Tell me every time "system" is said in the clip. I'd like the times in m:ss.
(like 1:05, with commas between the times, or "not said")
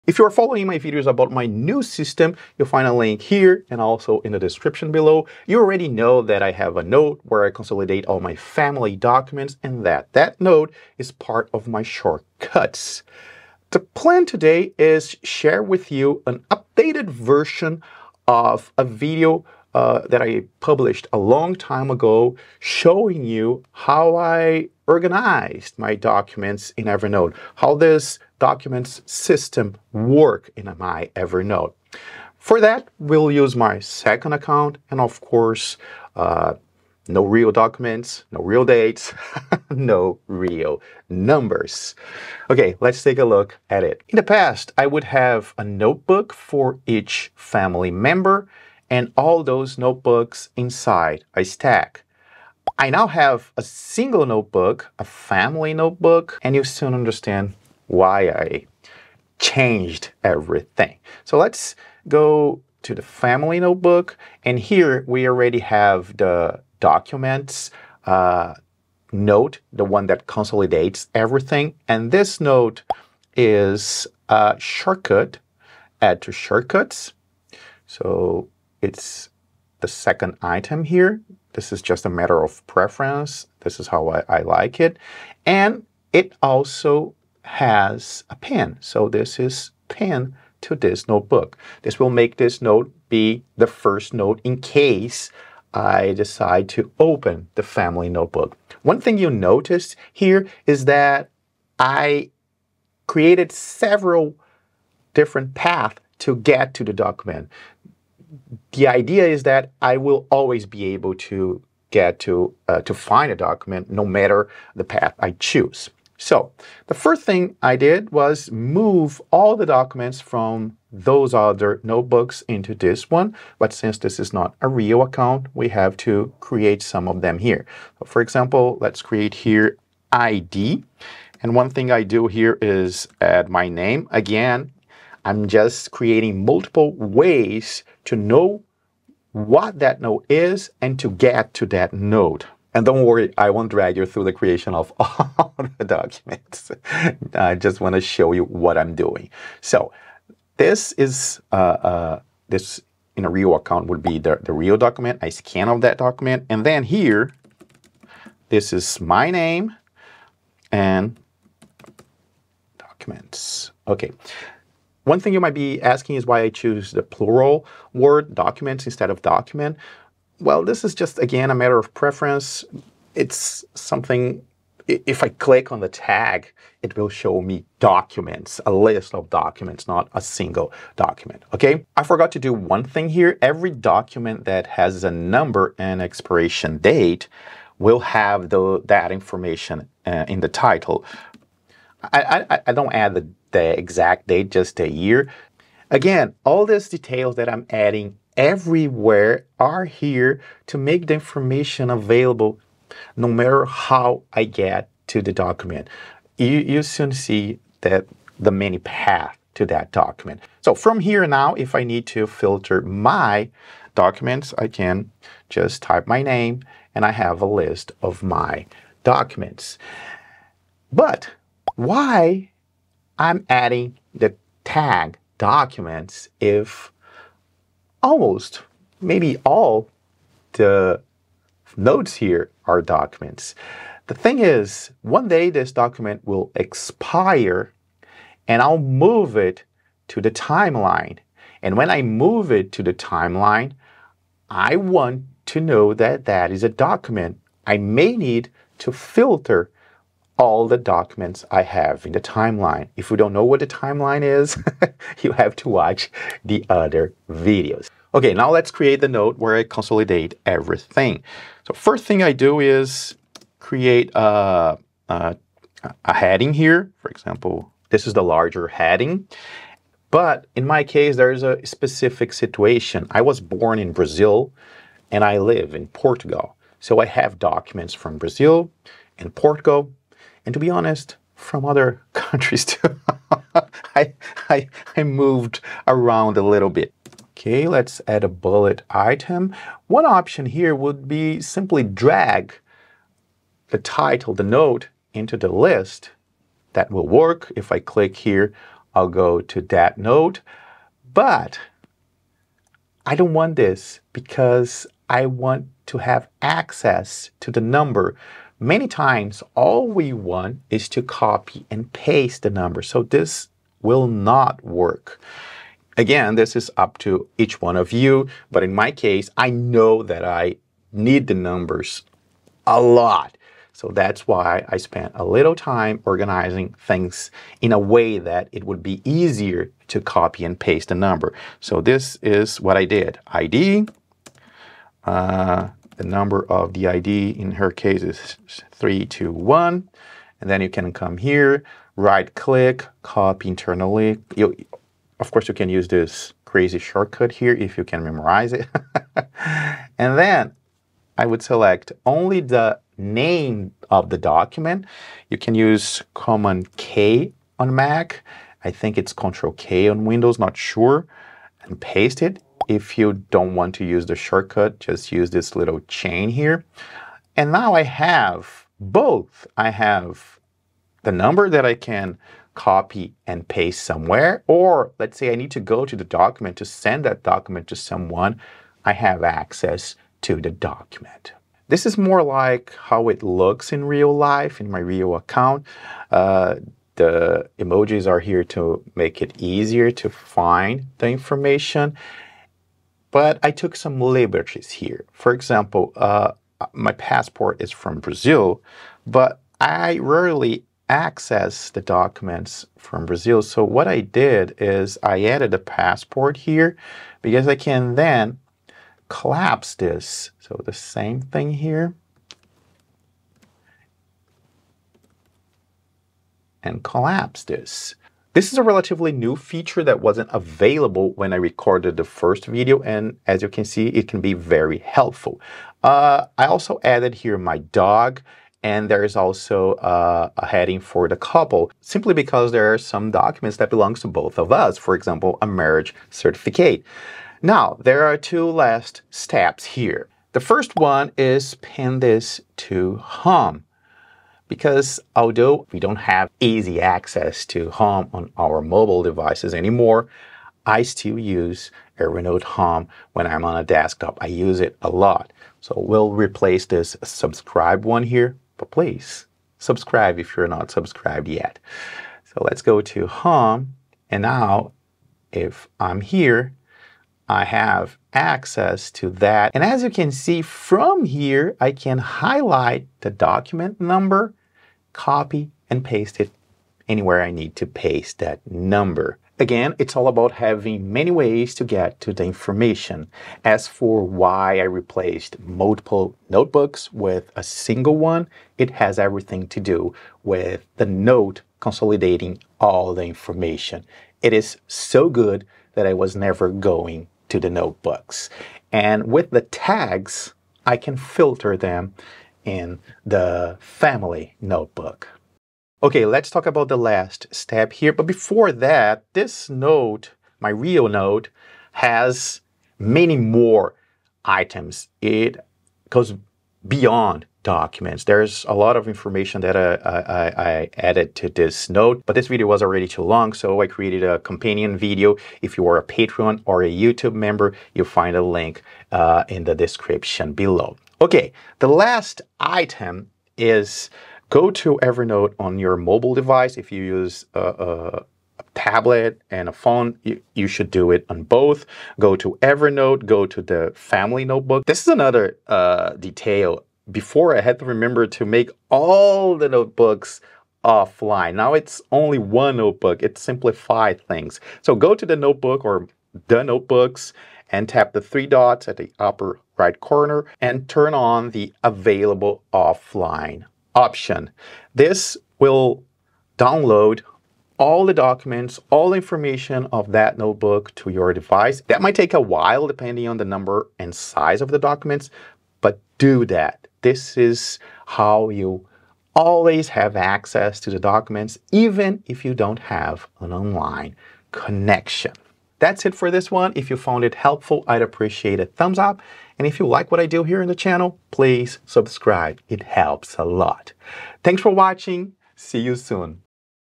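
0:01, 0:29.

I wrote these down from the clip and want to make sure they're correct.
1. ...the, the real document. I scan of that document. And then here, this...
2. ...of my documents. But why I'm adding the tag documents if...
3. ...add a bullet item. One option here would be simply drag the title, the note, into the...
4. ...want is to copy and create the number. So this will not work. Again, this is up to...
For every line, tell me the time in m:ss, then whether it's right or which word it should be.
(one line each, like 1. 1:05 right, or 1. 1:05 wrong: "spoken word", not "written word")
1. 2:34 right
2. 3:38 right
3. 4:48 right
4. 5:10 wrong: "paste", not "create".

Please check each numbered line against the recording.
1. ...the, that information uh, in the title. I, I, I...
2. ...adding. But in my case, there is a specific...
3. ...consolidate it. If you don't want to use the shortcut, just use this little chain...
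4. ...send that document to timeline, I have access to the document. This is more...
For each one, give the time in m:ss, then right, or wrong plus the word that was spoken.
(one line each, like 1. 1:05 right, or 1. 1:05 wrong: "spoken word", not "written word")
1. 3:08 right
2. 4:28 wrong: "heading", not "adding"
3. 6:01 wrong: "paste", not "consolidate"
4. 6:16 wrong: "someone", not "timeline".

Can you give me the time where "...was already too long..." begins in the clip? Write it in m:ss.
8:42.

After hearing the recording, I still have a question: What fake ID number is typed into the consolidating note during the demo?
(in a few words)
321.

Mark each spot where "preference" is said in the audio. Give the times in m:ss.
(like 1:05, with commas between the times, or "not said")
1:22, 2:51.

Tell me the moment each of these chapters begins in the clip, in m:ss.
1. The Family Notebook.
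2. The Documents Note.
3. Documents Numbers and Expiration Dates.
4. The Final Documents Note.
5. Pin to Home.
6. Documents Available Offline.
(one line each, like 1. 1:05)
1. 0:44
2. 1:55
3. 3:01
4. 6:21
5. 7:19
6. 8:25.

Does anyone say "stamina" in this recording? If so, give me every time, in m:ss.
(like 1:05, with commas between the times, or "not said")
not said.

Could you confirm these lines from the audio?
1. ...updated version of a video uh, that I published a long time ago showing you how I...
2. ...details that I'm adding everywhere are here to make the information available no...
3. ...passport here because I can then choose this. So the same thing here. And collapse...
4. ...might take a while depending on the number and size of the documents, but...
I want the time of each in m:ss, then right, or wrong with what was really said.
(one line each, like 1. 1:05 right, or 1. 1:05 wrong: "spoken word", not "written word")
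1. 0:16 right
2. 3:16 right
3. 6:45 wrong: "collapse", not "choose"
4. 9:31 right.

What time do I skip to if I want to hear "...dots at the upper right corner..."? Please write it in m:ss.
9:18.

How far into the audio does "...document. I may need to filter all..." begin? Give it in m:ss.
4:06.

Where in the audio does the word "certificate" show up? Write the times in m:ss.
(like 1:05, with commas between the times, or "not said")
7:16.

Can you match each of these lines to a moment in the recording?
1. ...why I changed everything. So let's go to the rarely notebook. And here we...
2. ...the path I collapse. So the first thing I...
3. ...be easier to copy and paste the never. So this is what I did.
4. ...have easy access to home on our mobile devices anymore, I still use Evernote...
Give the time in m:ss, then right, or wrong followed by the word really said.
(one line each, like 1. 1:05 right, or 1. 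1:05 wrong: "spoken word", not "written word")
1. 0:57 wrong: "family", not "rarely"
2. 1:54 wrong: "choose", not "collapse"
3. 5:28 wrong: "number", not "never"
4. 7:25 right.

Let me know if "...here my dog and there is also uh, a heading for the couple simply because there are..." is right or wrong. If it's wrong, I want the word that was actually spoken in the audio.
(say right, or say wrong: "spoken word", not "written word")
right.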